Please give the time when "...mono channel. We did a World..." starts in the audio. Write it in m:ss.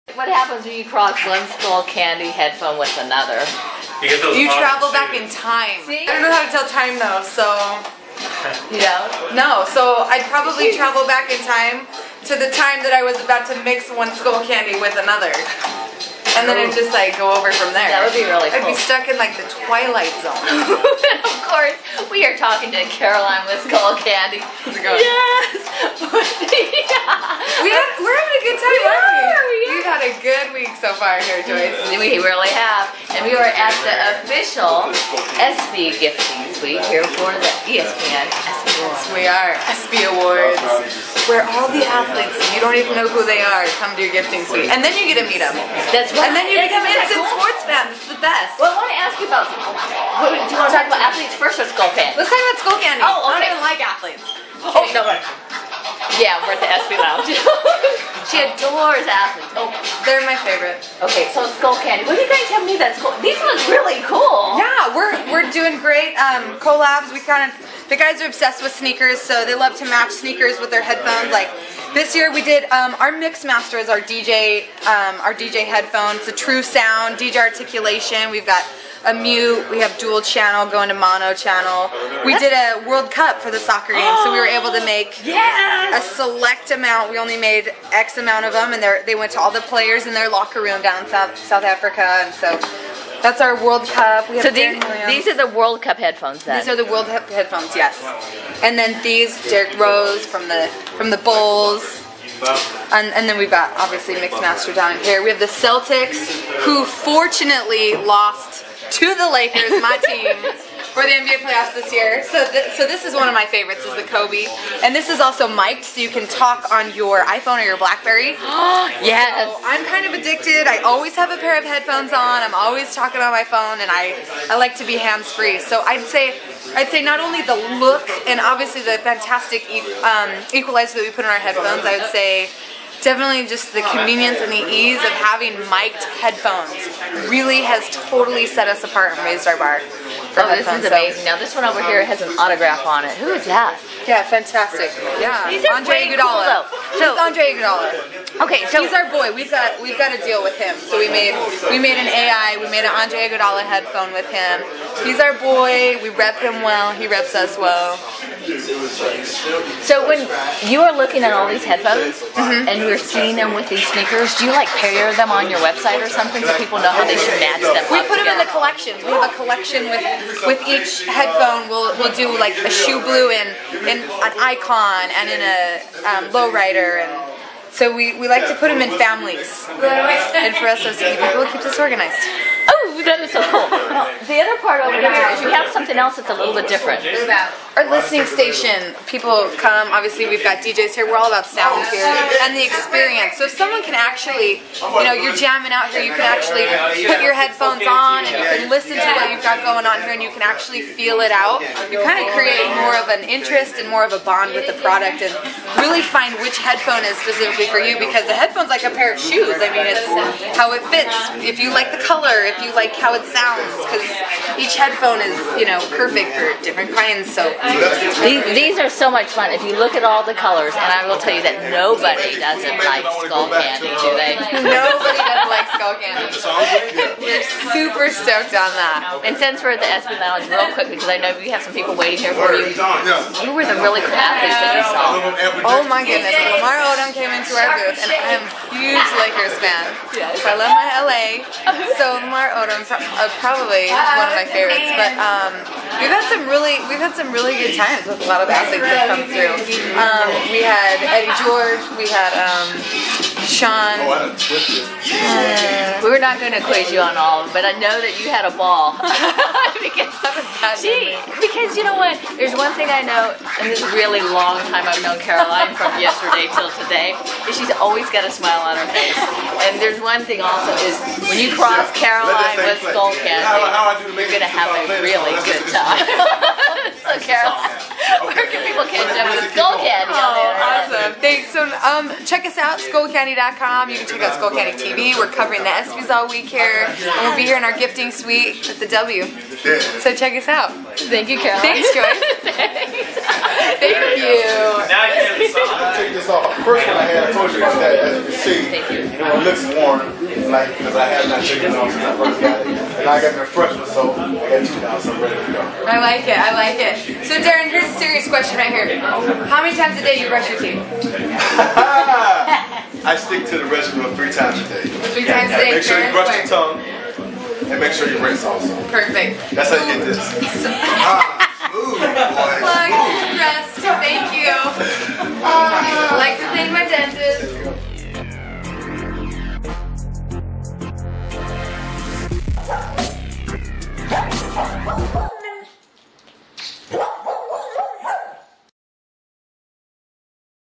1:20.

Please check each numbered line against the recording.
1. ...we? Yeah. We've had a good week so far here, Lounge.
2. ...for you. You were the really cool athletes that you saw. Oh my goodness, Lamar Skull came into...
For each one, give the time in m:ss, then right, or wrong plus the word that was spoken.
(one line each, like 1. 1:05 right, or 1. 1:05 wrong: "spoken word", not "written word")
1. 0:29 wrong: "Joyce", not "Lounge"
2. 3:52 wrong: "Odom", not "Skull".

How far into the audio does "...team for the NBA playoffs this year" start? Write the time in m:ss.
1:50.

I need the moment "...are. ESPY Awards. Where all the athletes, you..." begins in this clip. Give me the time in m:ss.
0:39.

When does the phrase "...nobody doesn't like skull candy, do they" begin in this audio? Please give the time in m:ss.
3:41.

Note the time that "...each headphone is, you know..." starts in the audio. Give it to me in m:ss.
3:34.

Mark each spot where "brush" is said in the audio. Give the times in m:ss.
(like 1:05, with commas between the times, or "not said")
5:10, 5:16.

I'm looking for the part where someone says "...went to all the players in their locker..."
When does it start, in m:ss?
1:29.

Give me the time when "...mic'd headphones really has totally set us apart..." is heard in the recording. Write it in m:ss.
2:15.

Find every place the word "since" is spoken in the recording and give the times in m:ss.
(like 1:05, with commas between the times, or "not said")
3:49, 5:01.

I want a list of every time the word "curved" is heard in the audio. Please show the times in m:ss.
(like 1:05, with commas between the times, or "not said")
not said.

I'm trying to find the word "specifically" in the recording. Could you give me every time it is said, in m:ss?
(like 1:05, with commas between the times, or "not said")
3:27.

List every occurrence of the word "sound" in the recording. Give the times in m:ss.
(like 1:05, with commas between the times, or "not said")
1:16, 3:11, 3:33.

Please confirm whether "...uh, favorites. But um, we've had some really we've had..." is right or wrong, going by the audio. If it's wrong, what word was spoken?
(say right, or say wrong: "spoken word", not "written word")
right.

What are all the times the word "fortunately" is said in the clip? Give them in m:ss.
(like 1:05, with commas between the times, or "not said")
1:46.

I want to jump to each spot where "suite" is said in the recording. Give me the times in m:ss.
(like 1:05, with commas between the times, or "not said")
0:36, 0:44, 4:48.